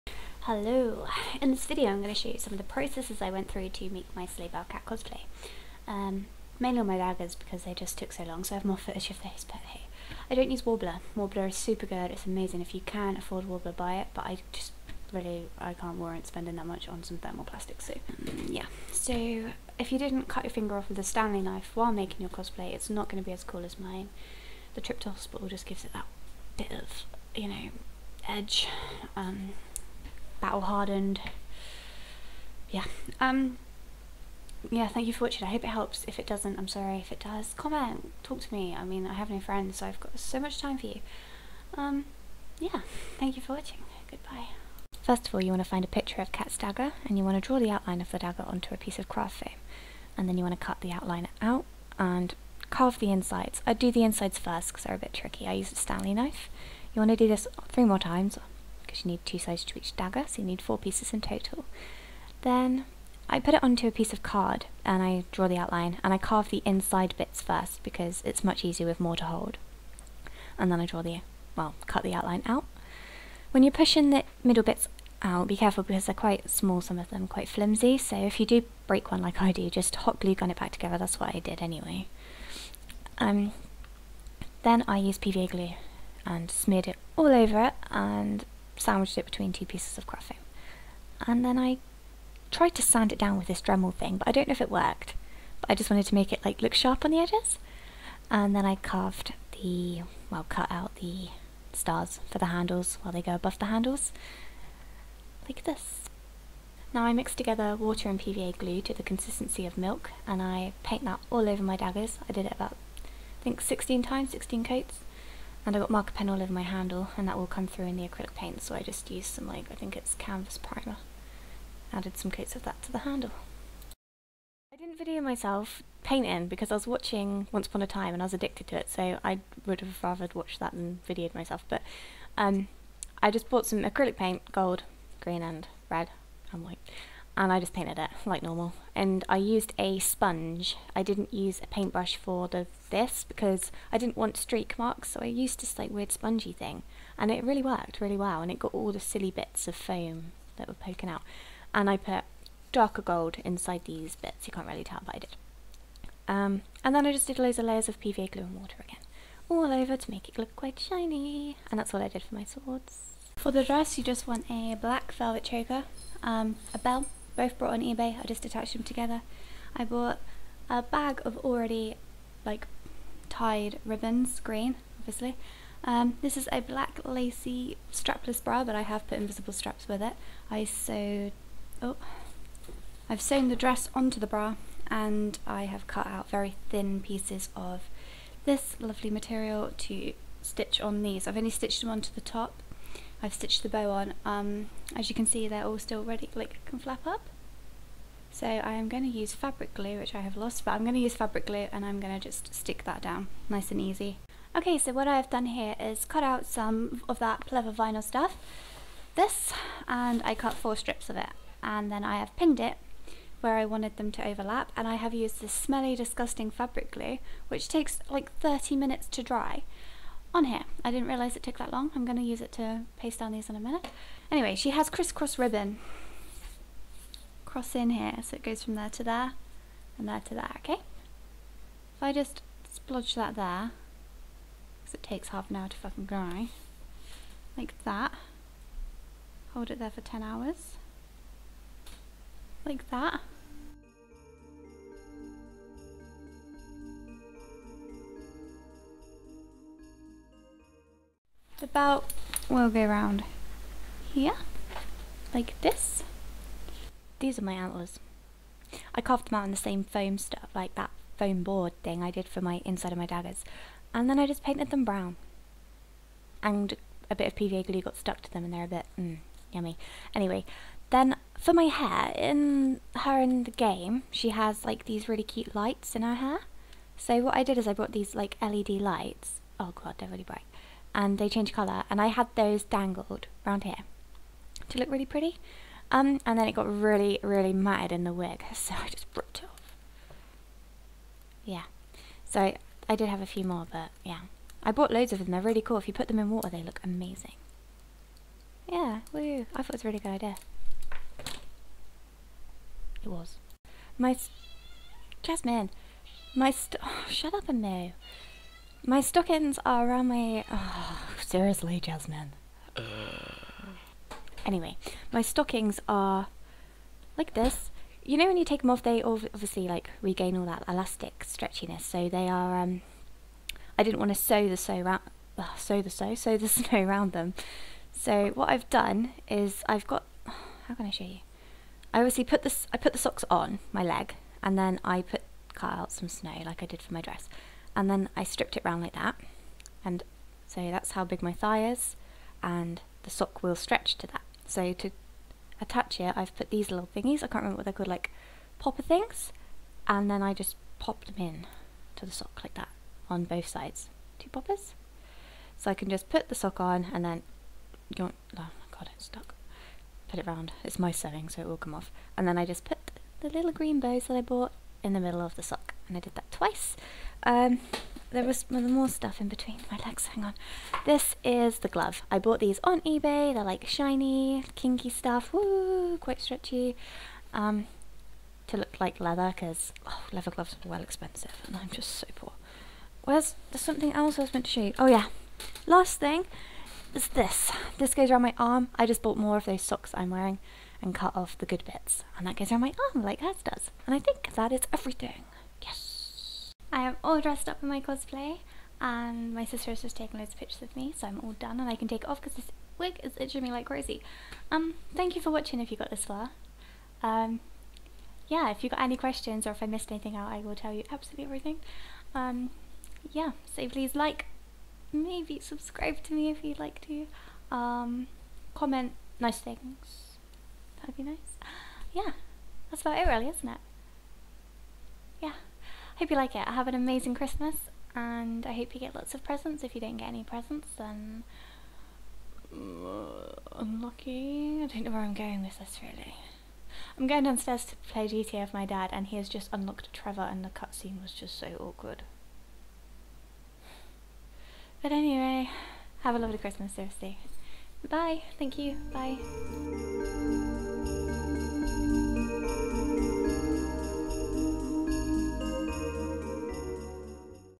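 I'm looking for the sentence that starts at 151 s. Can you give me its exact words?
And I put darker gold inside these bits.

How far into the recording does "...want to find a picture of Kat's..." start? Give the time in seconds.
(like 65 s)
45 s.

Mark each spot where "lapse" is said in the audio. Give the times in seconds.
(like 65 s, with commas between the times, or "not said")
not said.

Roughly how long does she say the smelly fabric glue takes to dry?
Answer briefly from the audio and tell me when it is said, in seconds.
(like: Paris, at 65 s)
30 minutes, at 218 s.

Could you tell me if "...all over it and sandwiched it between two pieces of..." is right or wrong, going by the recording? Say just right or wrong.
right.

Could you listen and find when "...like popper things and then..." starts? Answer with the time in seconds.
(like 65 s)
347 s.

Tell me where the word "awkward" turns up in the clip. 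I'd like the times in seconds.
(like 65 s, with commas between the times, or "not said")
441 s.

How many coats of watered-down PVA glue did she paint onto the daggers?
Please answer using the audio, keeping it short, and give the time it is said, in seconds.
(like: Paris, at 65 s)
16, at 114 s.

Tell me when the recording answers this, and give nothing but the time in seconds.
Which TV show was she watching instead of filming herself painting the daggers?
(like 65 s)
127 s.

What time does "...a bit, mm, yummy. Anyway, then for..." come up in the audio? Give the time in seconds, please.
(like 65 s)
268 s.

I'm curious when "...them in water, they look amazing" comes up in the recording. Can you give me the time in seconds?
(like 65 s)
296 s.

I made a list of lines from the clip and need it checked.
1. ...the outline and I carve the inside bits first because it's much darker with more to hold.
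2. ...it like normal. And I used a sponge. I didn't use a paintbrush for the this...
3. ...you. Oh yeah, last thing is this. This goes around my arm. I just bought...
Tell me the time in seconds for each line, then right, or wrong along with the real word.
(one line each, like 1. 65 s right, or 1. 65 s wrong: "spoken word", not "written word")
1. 65 s wrong: "easier", not "darker"
2. 137 s right
3. 384 s right.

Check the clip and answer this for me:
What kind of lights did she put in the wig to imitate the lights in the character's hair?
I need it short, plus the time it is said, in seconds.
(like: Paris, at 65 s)
LED lights, at 278 s.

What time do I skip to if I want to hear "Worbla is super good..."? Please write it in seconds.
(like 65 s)
11 s.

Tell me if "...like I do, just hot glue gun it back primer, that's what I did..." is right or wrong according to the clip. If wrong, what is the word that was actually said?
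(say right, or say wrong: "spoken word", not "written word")
wrong: "together", not "primer".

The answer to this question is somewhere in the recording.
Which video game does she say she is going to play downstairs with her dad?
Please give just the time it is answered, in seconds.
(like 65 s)
438 s.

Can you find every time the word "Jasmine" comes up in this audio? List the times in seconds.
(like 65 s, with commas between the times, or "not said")
305 s, 311 s.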